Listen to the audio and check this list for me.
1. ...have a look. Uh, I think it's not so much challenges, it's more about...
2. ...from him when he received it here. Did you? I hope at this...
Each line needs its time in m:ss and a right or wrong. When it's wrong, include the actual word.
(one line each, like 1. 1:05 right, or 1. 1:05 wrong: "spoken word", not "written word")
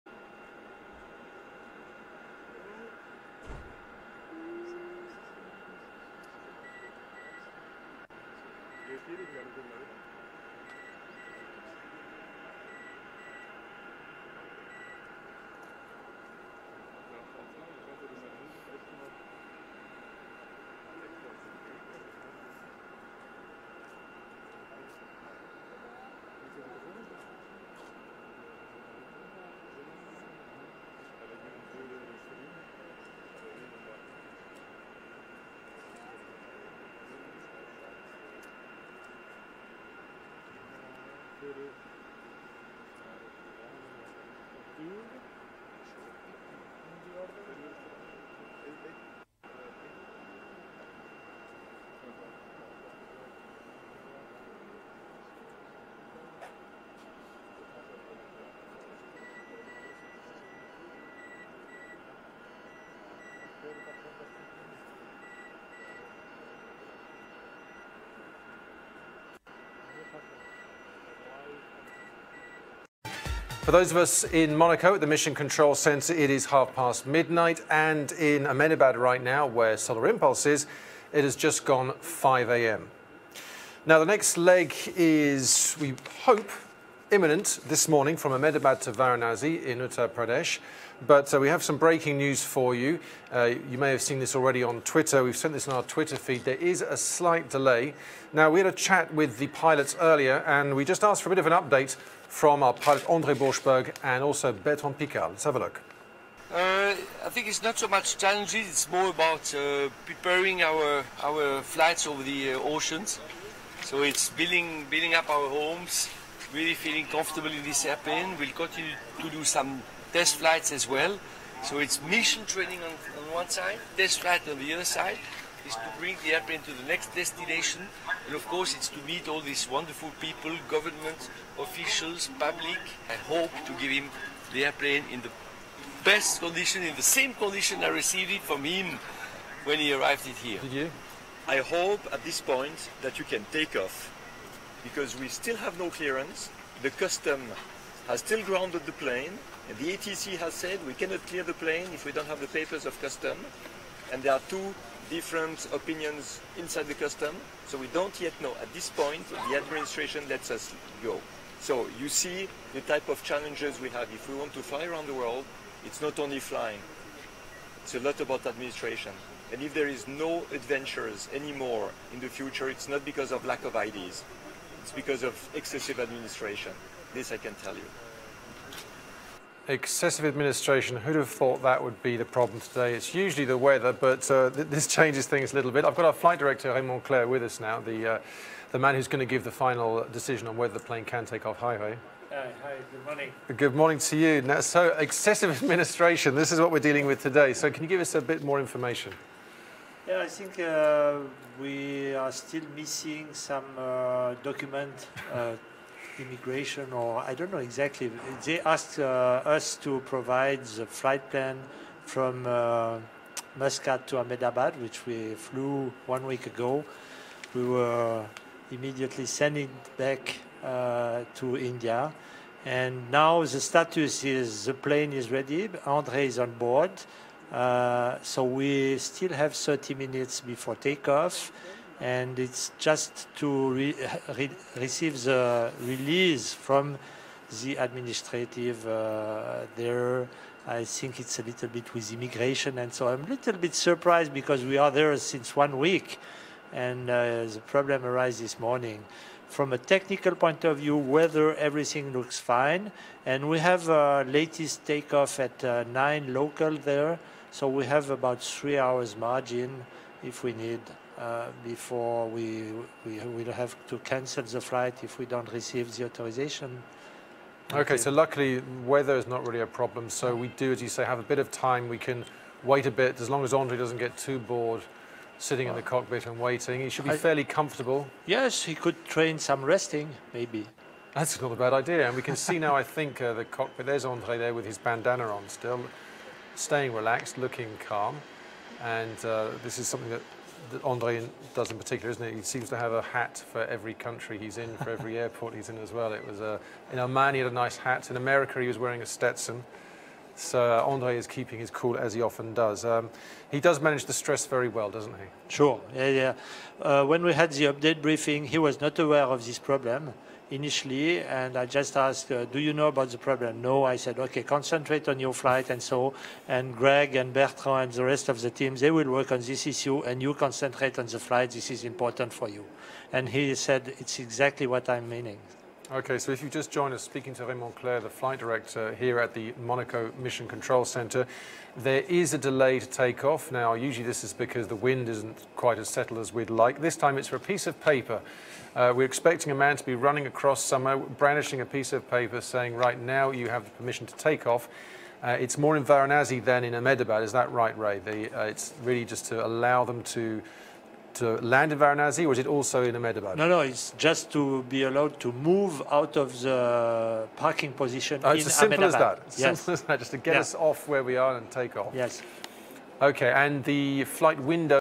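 1. 1:45 right
2. 2:18 wrong: "arrived", not "received".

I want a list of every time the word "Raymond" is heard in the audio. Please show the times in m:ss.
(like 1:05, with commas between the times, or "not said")
3:06, 5:27.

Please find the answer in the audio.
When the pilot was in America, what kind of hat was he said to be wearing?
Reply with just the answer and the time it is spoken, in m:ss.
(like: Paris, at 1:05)
Stetson, at 4:59.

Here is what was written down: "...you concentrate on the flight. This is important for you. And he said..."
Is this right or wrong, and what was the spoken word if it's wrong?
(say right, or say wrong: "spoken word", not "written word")
right.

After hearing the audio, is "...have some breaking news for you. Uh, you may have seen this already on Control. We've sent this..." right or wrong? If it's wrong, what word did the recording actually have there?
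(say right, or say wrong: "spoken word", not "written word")
wrong: "Twitter", not "Control".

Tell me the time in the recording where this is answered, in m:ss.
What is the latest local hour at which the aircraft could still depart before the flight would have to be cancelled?
4:15.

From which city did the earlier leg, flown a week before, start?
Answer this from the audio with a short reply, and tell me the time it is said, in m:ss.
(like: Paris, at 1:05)
Muscat, at 3:33.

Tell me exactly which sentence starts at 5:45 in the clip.
Uh, it's more in Varanasi than in Ahmedabad.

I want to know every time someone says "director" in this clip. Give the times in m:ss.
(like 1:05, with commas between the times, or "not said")
3:06, 5:28.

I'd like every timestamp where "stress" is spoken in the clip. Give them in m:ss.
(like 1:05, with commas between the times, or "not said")
5:04.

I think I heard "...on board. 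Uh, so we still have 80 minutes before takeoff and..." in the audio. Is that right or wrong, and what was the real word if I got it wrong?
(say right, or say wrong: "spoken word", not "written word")
wrong: "30", not "80".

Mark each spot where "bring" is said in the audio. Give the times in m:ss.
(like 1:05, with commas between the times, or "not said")
2:05.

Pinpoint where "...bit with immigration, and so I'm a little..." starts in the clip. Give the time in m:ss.
4:01.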